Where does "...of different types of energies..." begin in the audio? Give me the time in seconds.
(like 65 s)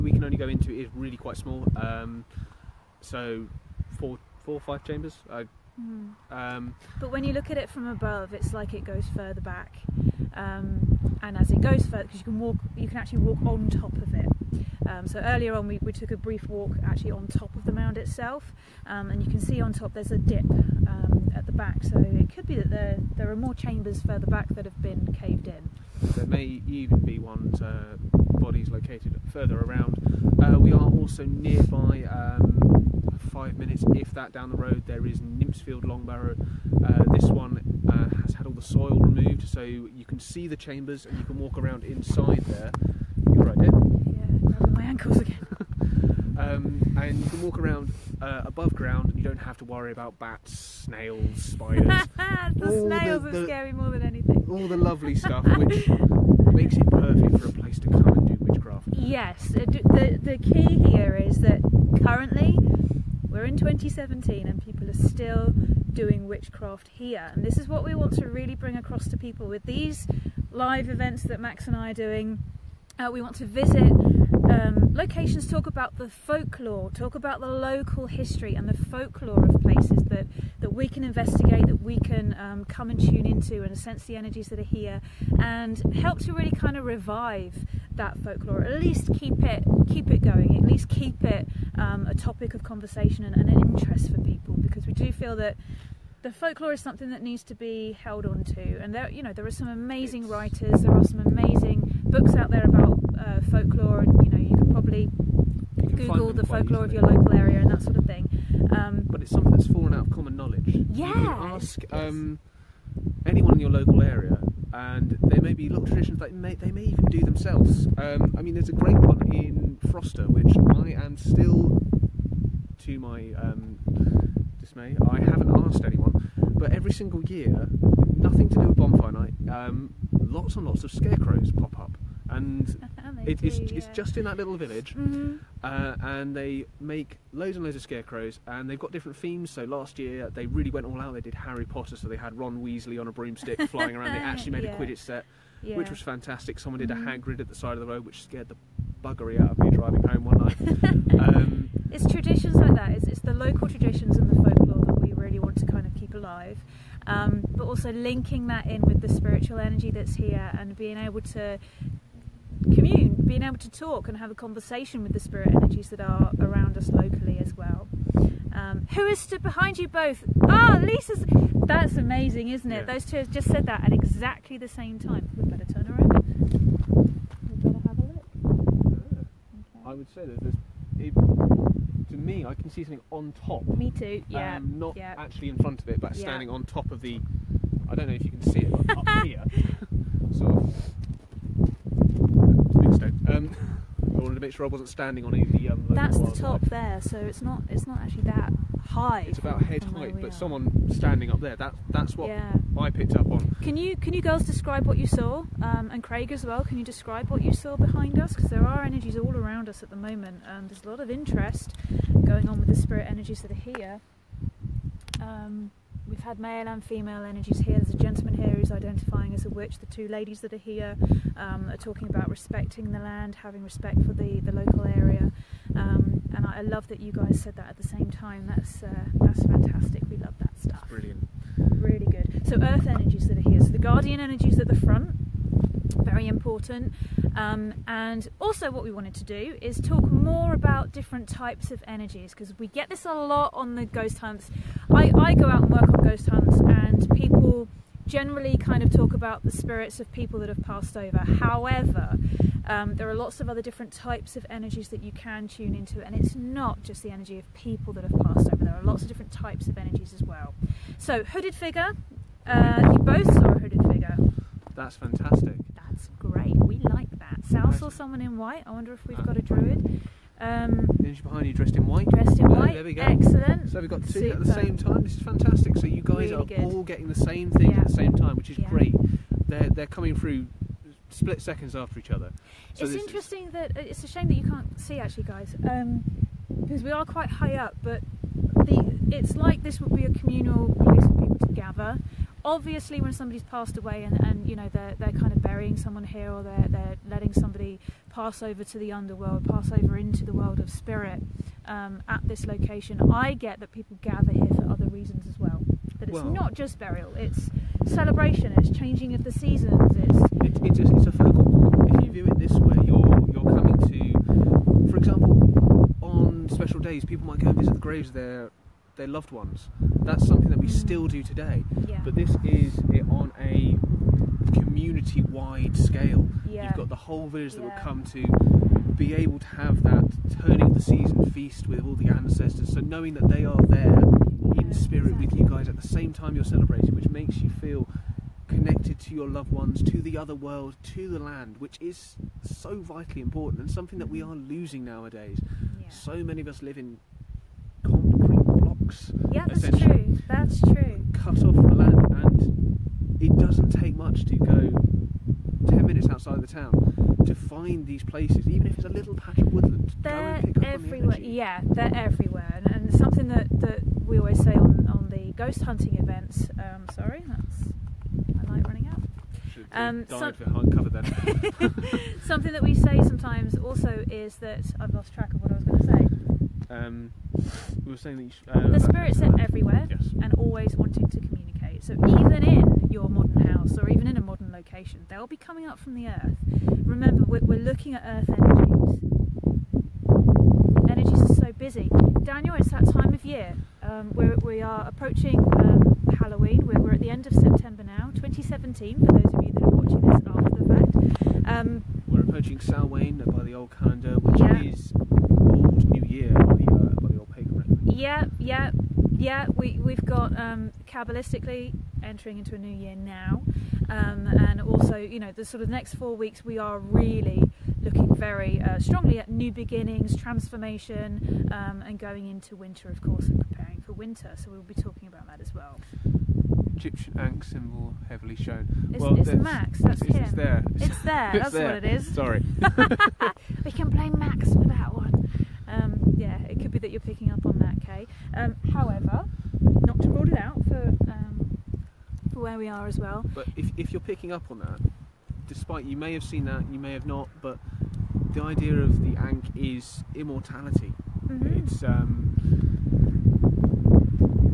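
259 s.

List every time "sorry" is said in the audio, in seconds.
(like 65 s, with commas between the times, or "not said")
366 s, 432 s.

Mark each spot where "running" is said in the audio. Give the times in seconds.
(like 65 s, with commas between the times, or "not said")
368 s.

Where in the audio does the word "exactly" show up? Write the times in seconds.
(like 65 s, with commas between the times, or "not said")
173 s, 335 s.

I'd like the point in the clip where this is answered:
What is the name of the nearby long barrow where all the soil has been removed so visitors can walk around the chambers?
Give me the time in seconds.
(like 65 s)
35 s.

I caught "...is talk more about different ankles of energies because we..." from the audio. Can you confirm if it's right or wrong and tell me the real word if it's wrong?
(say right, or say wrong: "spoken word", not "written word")
wrong: "types", not "ankles".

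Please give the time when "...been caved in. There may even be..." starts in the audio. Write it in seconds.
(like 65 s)
24 s.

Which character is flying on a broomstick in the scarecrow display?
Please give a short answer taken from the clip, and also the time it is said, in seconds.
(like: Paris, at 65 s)
Ron Weasley, at 142 s.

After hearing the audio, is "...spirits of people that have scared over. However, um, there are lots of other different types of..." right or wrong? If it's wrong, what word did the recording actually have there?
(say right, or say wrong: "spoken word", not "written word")
wrong: "passed", not "scared".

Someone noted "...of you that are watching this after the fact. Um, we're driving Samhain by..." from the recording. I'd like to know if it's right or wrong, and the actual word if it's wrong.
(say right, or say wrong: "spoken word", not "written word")
wrong: "approaching", not "driving".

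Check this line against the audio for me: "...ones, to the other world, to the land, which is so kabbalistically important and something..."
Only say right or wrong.
wrong.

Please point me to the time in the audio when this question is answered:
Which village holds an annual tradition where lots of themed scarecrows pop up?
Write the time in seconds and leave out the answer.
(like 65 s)
119 s.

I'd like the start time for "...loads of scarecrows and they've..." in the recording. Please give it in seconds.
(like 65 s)
137 s.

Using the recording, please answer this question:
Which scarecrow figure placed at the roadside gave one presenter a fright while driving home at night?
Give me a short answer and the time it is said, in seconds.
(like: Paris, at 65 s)
Hagrid, at 147 s.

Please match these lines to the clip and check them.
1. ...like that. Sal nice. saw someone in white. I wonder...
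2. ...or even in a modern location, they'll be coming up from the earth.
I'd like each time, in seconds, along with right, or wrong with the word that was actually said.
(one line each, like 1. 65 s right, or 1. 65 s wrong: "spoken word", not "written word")
1. 266 s right
2. 383 s right.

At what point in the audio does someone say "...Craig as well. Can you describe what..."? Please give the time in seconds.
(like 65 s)
206 s.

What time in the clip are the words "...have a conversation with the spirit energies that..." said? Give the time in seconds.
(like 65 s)
164 s.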